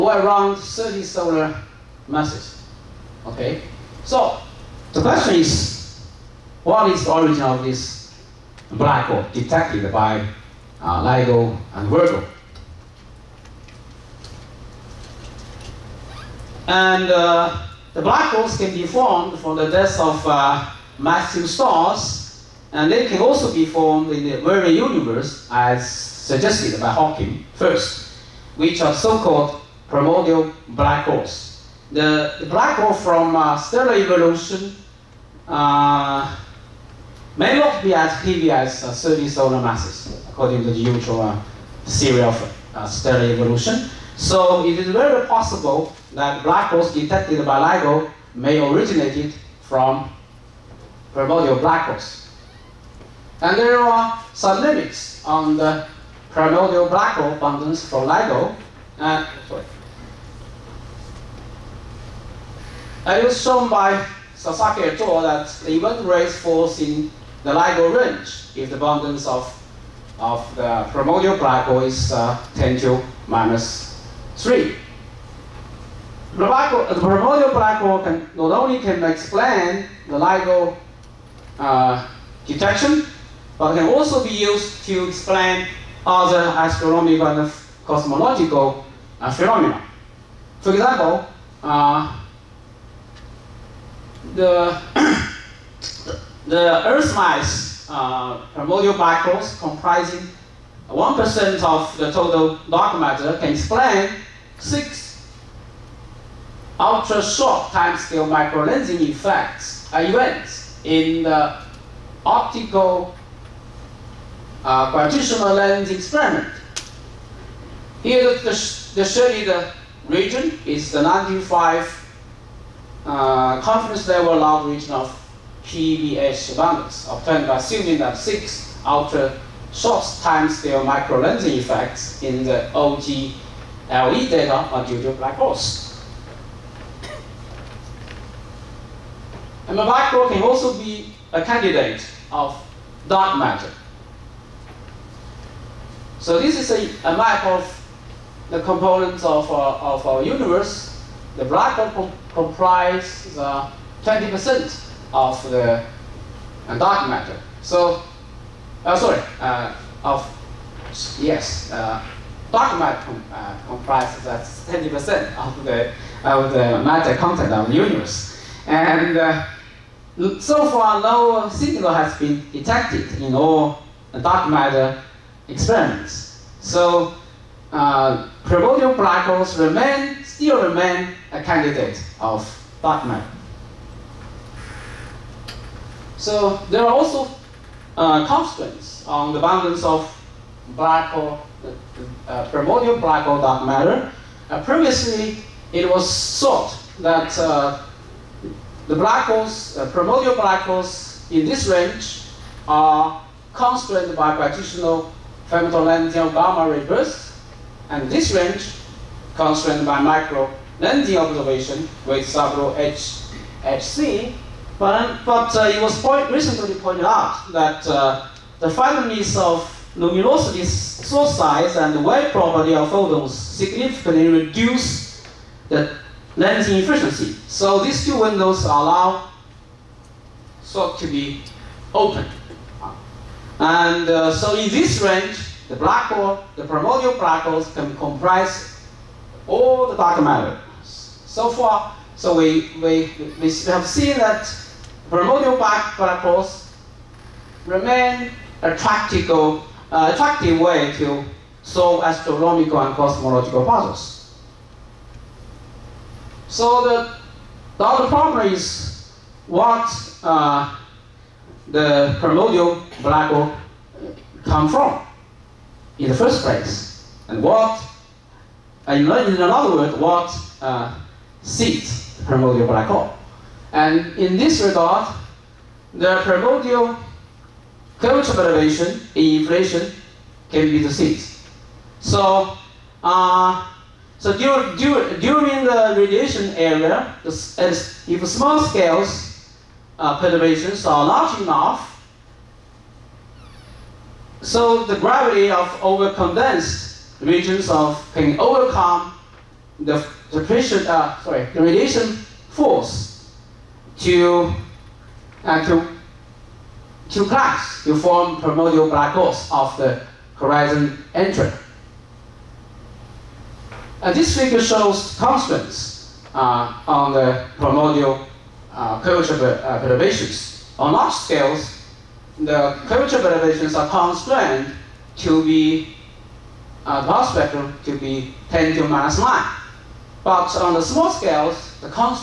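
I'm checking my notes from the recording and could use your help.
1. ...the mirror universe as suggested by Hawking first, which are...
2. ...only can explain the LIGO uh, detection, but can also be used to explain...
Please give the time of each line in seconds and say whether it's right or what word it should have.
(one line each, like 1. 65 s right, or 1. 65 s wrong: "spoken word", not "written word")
1. 24 s right
2. 78 s right.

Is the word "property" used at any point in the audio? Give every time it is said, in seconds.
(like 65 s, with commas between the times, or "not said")
222 s.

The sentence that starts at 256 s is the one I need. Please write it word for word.
So the, the other problem is what uh, the primordial black hole come from in the first place?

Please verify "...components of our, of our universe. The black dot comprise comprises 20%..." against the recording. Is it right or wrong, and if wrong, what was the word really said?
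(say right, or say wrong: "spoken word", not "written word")
right.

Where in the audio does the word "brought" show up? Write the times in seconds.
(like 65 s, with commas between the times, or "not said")
not said.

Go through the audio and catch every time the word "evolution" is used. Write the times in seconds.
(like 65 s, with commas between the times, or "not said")
33 s, 43 s.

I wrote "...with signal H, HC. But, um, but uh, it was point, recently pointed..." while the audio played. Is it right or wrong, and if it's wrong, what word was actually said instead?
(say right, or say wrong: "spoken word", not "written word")
wrong: "several", not "signal".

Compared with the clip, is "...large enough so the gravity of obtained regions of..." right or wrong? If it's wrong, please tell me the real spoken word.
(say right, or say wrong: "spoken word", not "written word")
wrong: "overcondensed", not "obtained".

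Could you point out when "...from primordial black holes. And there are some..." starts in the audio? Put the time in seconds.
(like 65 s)
49 s.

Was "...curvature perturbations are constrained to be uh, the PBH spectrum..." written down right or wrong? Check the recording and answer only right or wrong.
wrong.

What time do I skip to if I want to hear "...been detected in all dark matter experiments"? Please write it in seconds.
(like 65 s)
172 s.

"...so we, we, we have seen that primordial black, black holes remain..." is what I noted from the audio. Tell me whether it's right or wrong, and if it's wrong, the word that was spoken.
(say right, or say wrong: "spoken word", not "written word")
right.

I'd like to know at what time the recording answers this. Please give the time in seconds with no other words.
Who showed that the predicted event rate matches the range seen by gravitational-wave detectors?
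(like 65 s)
64 s.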